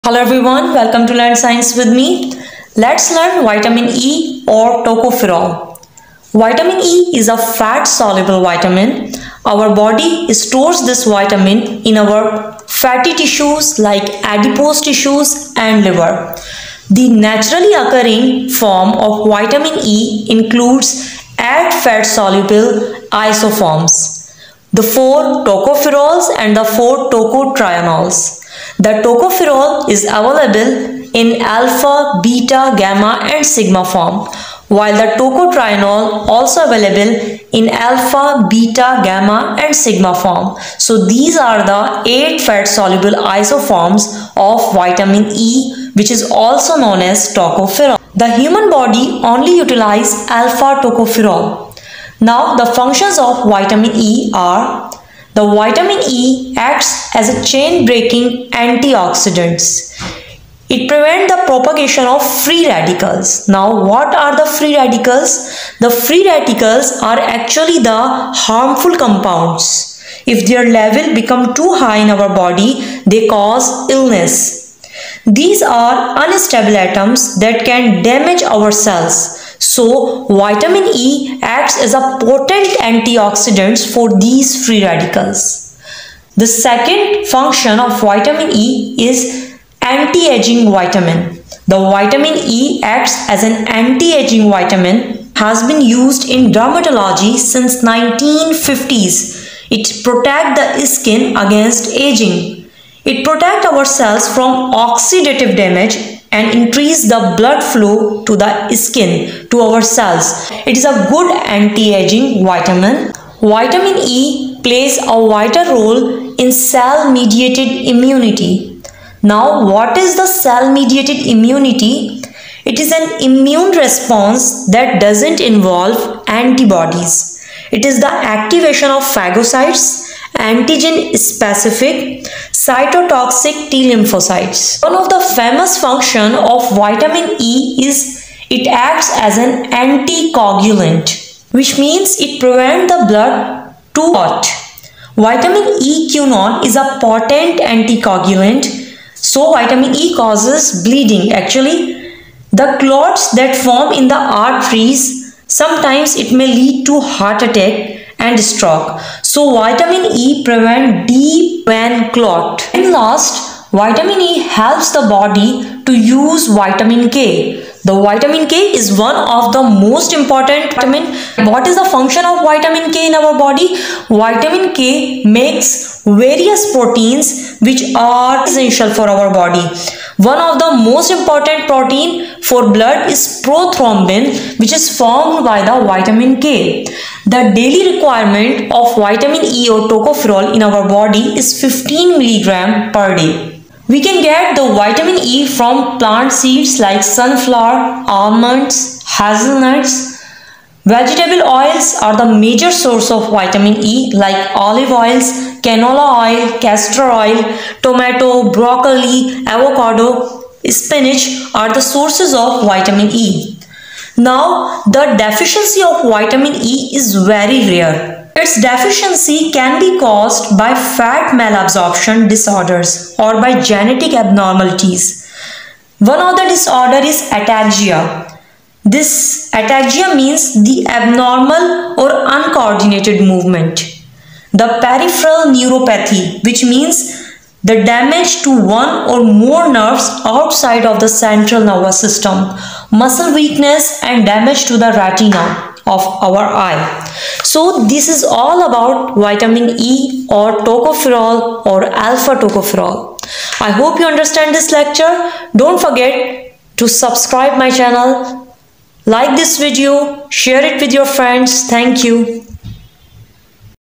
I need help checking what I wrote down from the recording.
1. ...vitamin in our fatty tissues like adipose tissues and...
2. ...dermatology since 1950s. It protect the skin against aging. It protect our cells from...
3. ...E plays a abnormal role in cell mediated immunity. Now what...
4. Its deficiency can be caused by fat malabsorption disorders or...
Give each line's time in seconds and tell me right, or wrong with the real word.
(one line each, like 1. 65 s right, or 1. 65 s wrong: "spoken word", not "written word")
1. 11 s right
2. 96 s right
3. 114 s wrong: "vital", not "abnormal"
4. 218 s right.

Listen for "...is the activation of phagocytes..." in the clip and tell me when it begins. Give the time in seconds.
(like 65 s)
127 s.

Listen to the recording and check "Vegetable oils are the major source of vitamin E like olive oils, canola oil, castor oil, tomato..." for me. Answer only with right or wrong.
right.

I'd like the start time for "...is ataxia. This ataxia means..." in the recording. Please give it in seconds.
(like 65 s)
227 s.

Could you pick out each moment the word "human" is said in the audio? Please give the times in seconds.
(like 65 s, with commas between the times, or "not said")
48 s.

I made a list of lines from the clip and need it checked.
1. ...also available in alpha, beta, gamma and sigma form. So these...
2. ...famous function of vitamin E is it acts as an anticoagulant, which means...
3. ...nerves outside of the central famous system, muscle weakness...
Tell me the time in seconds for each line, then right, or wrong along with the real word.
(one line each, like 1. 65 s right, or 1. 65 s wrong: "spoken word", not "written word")
1. 36 s right
2. 135 s right
3. 239 s wrong: "nervous", not "famous".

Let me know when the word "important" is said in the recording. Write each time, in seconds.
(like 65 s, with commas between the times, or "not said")
170 s, 181 s.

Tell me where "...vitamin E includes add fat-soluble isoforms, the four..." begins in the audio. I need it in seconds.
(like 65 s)
19 s.